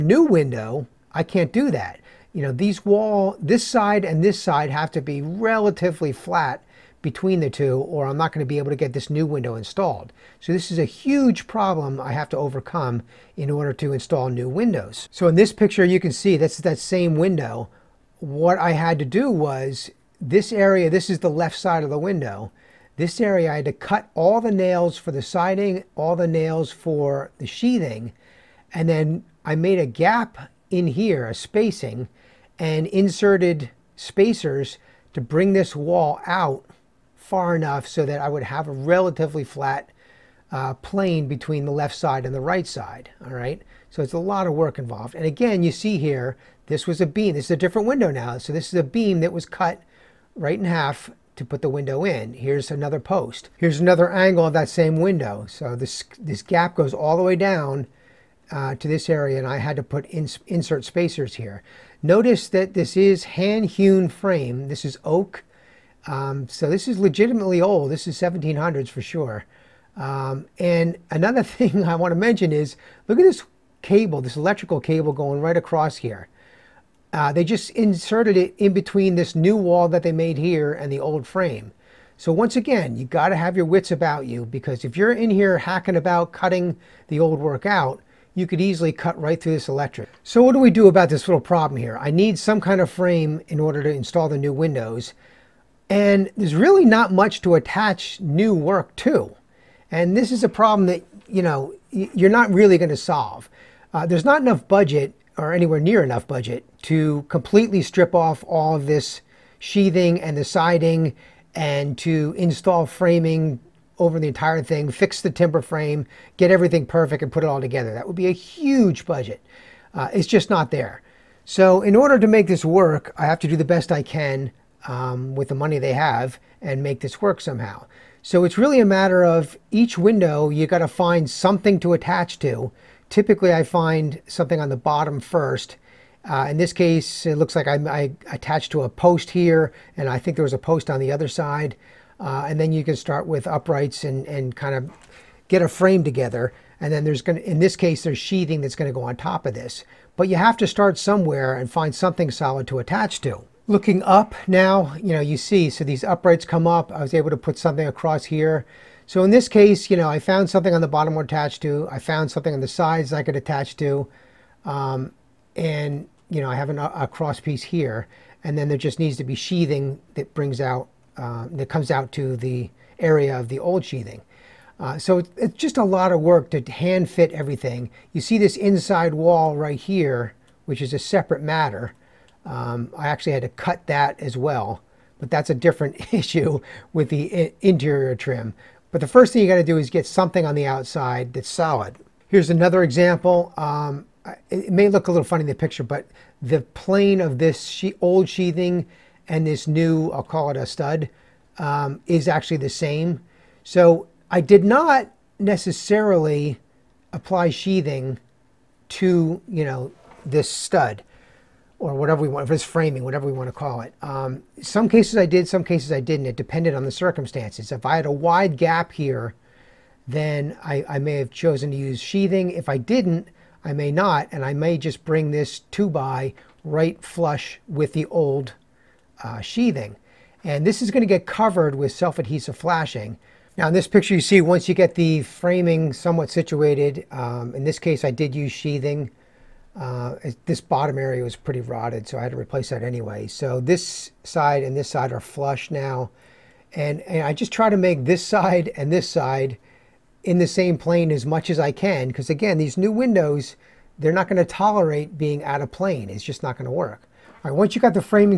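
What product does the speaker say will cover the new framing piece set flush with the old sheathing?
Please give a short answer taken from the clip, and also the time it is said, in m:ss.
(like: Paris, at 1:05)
Self-adhesive flashing, at 3:51.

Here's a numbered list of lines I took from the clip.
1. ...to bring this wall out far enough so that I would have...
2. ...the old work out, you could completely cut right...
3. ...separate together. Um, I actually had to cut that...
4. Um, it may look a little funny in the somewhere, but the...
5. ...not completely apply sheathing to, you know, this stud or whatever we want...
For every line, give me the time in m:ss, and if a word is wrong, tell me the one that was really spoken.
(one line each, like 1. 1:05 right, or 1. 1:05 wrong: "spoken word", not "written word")
1. 0:35 right
2. 1:27 wrong: "easily", not "completely"
3. 3:00 wrong: "matter", not "together"
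4. 3:13 wrong: "picture", not "somewhere"
5. 3:24 wrong: "necessarily", not "completely".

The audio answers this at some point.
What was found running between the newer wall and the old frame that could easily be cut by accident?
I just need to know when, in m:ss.
1:14.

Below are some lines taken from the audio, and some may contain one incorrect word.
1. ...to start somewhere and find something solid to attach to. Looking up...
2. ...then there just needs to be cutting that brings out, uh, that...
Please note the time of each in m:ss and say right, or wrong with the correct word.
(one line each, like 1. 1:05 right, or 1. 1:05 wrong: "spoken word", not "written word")
1. 2:30 right
2. 2:48 wrong: "sheathing", not "cutting".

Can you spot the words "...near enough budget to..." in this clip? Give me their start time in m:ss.
1:45.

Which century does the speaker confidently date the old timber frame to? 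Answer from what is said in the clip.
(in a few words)
1700s.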